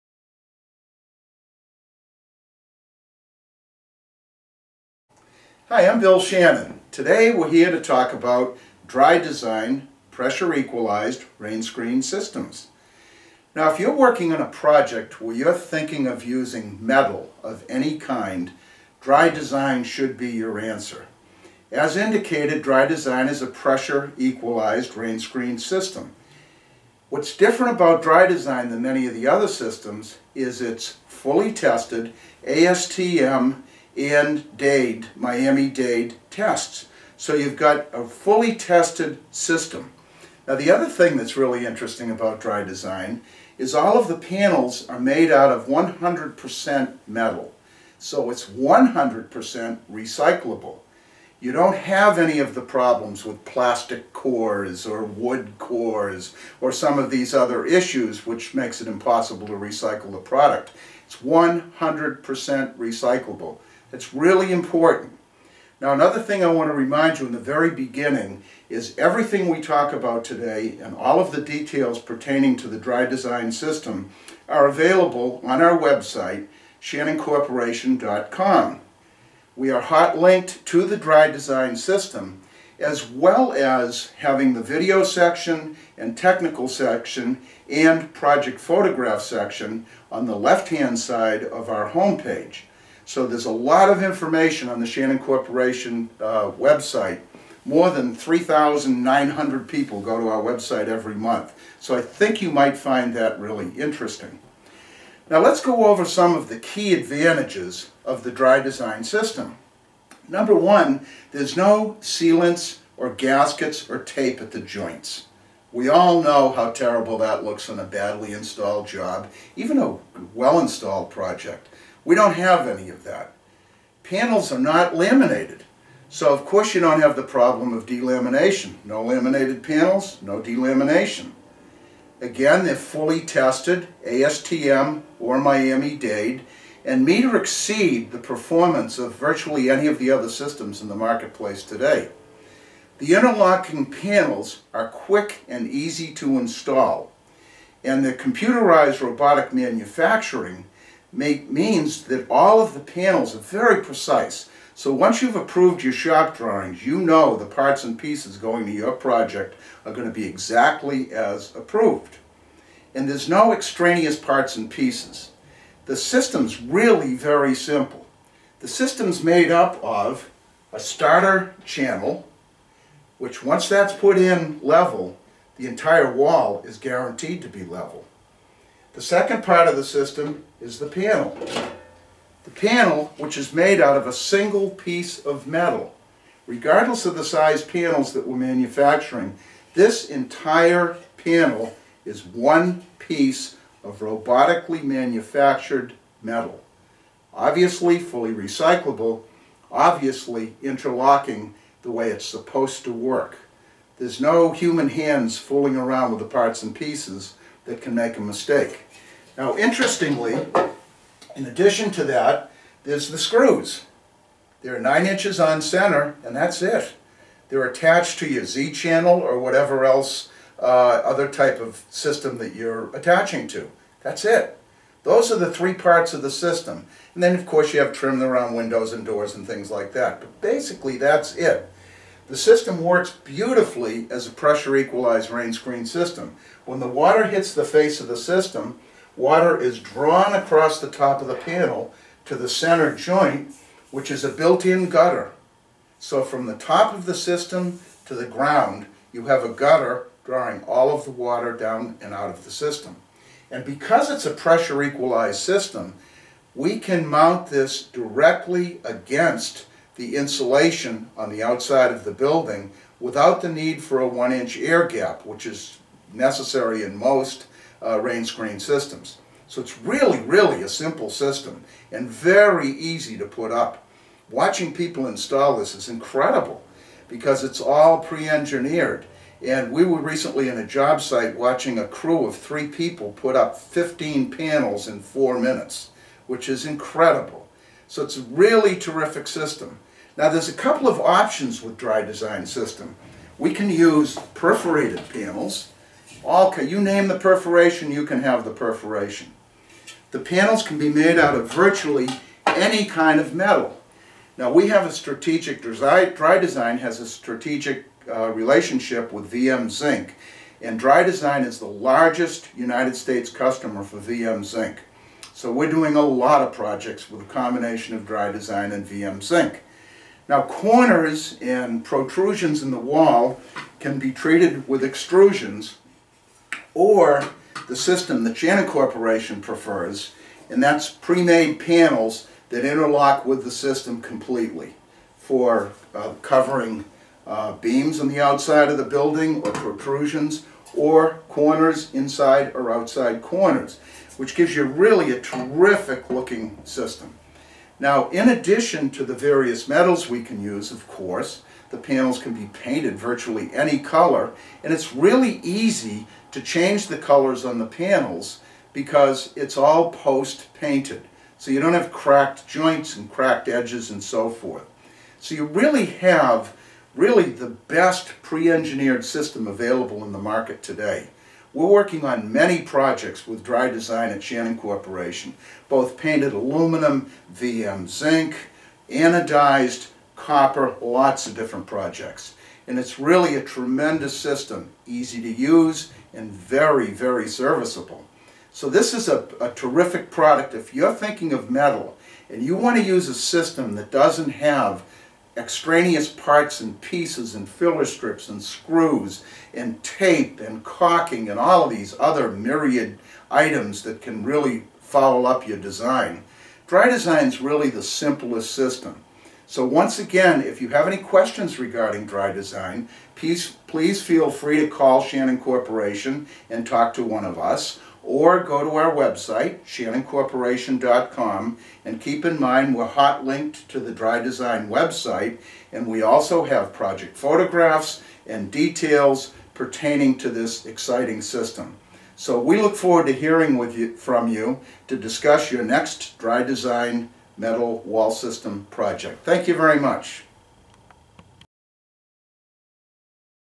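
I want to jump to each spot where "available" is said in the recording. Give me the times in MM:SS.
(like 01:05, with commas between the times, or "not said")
01:14, 06:09.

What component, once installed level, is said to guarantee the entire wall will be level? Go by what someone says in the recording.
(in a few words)
starter channel.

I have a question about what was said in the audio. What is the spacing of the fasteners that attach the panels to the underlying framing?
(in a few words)
9 inches on center.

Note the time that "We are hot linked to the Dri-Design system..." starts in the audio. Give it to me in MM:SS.
01:19.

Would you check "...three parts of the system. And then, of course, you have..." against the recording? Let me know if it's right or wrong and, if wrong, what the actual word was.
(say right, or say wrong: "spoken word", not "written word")
right.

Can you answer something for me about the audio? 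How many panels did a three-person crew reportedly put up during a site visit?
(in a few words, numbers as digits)
15.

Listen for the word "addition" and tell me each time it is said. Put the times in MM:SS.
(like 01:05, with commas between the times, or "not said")
03:31, 05:48.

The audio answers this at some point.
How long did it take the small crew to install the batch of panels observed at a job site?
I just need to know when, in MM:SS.
04:45.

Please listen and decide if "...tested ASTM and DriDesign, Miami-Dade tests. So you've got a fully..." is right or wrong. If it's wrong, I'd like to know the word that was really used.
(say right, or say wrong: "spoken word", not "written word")
wrong: "Dade", not "DriDesign".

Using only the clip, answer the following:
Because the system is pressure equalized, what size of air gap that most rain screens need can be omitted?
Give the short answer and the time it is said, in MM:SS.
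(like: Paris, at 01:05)
1 inch, at 04:24.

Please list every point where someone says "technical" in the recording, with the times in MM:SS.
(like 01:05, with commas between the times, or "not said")
01:26.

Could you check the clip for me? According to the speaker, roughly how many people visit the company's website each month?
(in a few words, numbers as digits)
3,900.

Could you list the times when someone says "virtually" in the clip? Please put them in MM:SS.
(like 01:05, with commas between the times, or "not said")
02:19, 05:01, 05:52.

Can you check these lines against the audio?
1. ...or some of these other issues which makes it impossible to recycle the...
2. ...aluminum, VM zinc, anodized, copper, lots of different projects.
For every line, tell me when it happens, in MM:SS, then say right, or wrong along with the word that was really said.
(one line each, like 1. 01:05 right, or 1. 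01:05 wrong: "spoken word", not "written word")
1. 00:56 right
2. 06:16 right.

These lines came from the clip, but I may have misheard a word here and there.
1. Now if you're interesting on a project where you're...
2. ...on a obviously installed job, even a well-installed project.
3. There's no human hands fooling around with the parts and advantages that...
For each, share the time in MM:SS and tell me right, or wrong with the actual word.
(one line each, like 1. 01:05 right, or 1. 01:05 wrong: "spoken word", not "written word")
1. 00:13 wrong: "working", not "interesting"
2. 01:57 wrong: "badly", not "obviously"
3. 03:23 wrong: "pieces", not "advantages".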